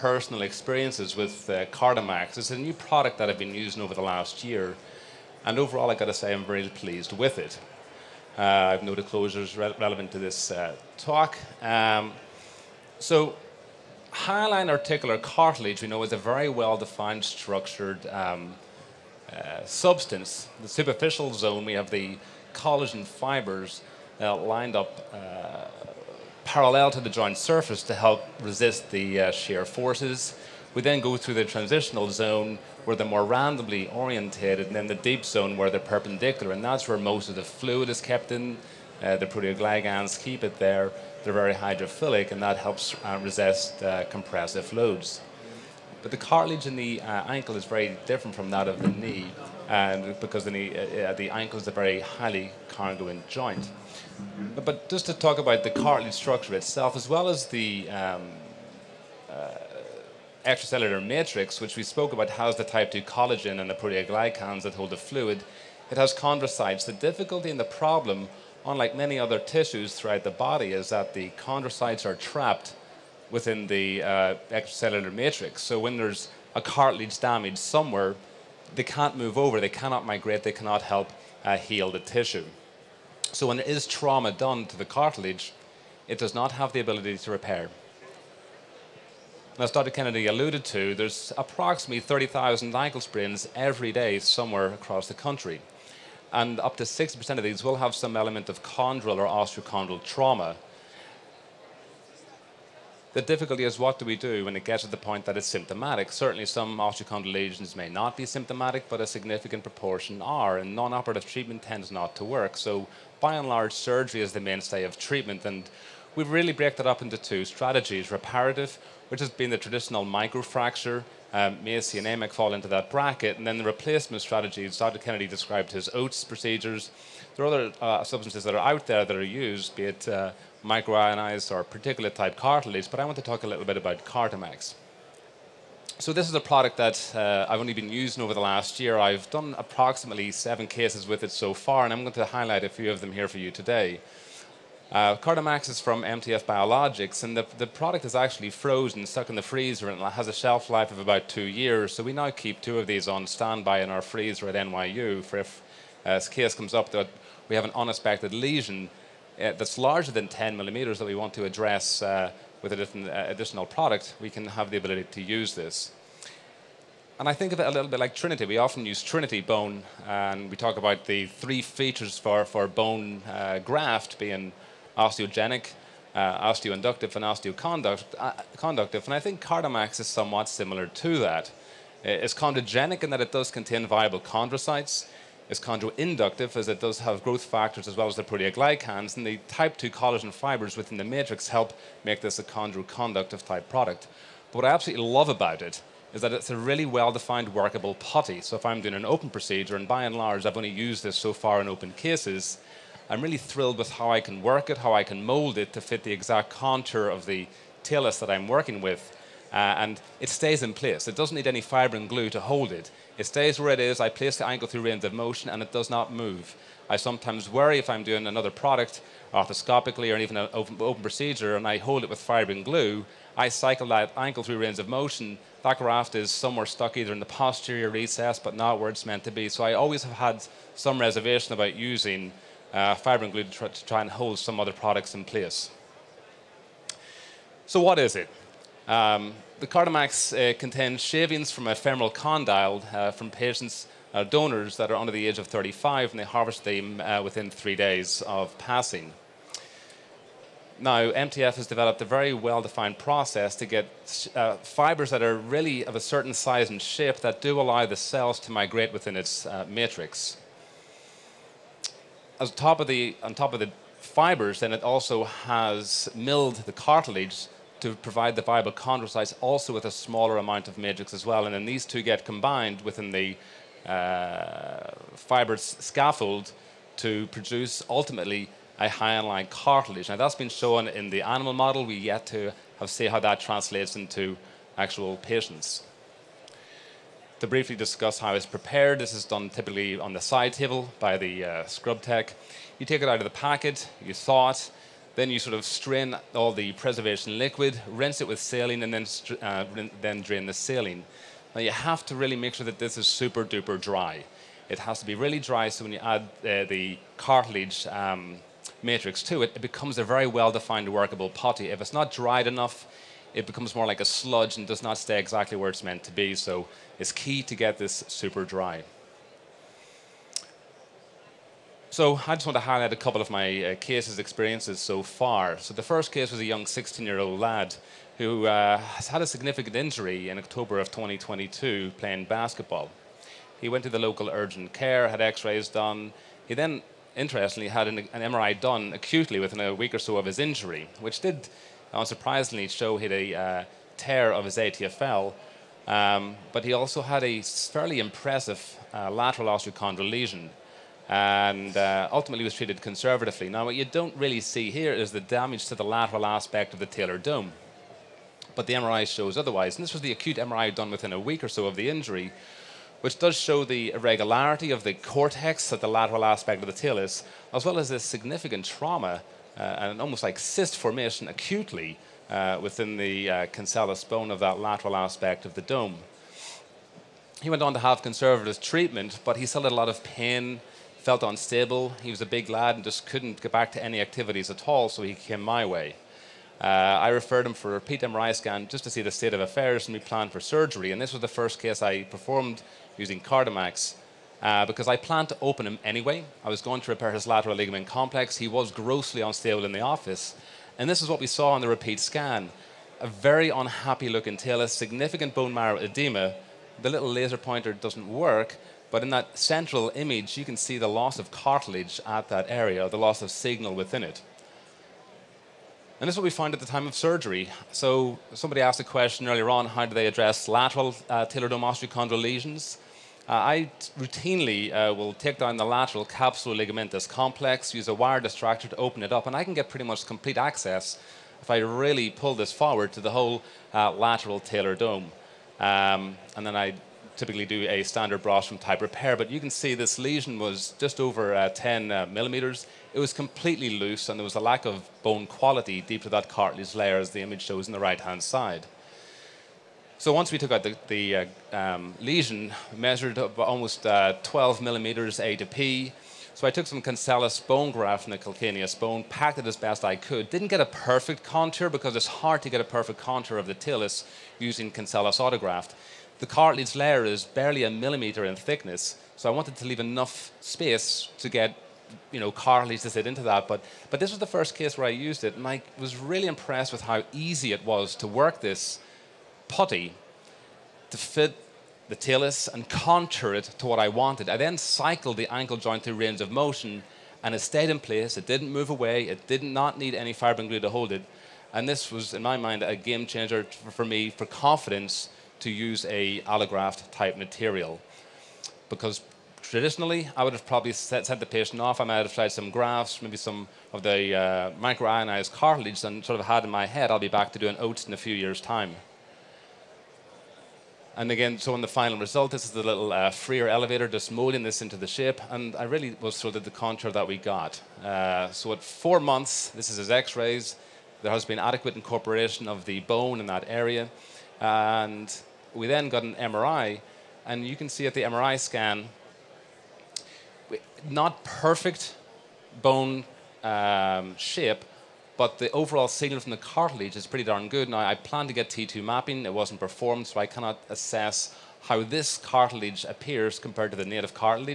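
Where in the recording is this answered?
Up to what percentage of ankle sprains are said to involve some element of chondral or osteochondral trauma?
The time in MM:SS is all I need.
01:36.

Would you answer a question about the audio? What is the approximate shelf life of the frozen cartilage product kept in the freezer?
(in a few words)
2 years.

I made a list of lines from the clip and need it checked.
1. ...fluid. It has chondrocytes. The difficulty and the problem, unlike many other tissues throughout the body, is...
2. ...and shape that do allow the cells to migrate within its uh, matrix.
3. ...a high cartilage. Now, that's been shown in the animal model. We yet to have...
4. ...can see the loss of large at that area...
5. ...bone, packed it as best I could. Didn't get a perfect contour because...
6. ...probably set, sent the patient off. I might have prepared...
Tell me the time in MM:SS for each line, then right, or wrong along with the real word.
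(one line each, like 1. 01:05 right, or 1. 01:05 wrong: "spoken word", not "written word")
1. 01:04 right
2. 04:16 right
3. 04:38 right
4. 06:50 wrong: "cartilage", not "large"
5. 07:38 right
6. 08:20 wrong: "tried", not "prepared".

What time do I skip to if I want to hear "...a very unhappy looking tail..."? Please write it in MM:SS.
06:42.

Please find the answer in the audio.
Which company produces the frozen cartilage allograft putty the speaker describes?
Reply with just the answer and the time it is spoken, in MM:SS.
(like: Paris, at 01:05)
MTF Biologics, at 02:26.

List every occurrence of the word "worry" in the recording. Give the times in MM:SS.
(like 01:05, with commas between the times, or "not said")
03:37.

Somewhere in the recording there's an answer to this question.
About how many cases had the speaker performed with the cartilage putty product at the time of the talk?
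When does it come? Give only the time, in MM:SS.
02:20.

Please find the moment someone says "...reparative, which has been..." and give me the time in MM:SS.
01:58.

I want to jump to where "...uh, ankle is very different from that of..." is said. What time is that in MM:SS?
00:46.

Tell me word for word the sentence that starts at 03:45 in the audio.
That graft is somewhere stuck either in the posterior recess but not where it's meant to be.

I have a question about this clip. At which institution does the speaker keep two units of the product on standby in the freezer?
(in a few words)
NYU.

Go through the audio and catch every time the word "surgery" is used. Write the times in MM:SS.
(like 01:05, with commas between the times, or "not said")
01:53, 06:30, 06:56.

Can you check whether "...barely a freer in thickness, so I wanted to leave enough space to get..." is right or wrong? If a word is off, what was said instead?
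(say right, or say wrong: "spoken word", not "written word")
wrong: "millimeter", not "freer".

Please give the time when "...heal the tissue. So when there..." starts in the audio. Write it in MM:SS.
01:21.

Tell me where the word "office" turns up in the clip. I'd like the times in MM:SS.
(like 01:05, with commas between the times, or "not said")
06:39.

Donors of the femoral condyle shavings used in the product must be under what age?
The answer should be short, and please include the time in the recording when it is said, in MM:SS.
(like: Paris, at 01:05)
35, at 04:05.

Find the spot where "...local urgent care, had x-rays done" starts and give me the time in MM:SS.
05:33.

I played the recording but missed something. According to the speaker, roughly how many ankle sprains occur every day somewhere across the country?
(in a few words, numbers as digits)
30,000.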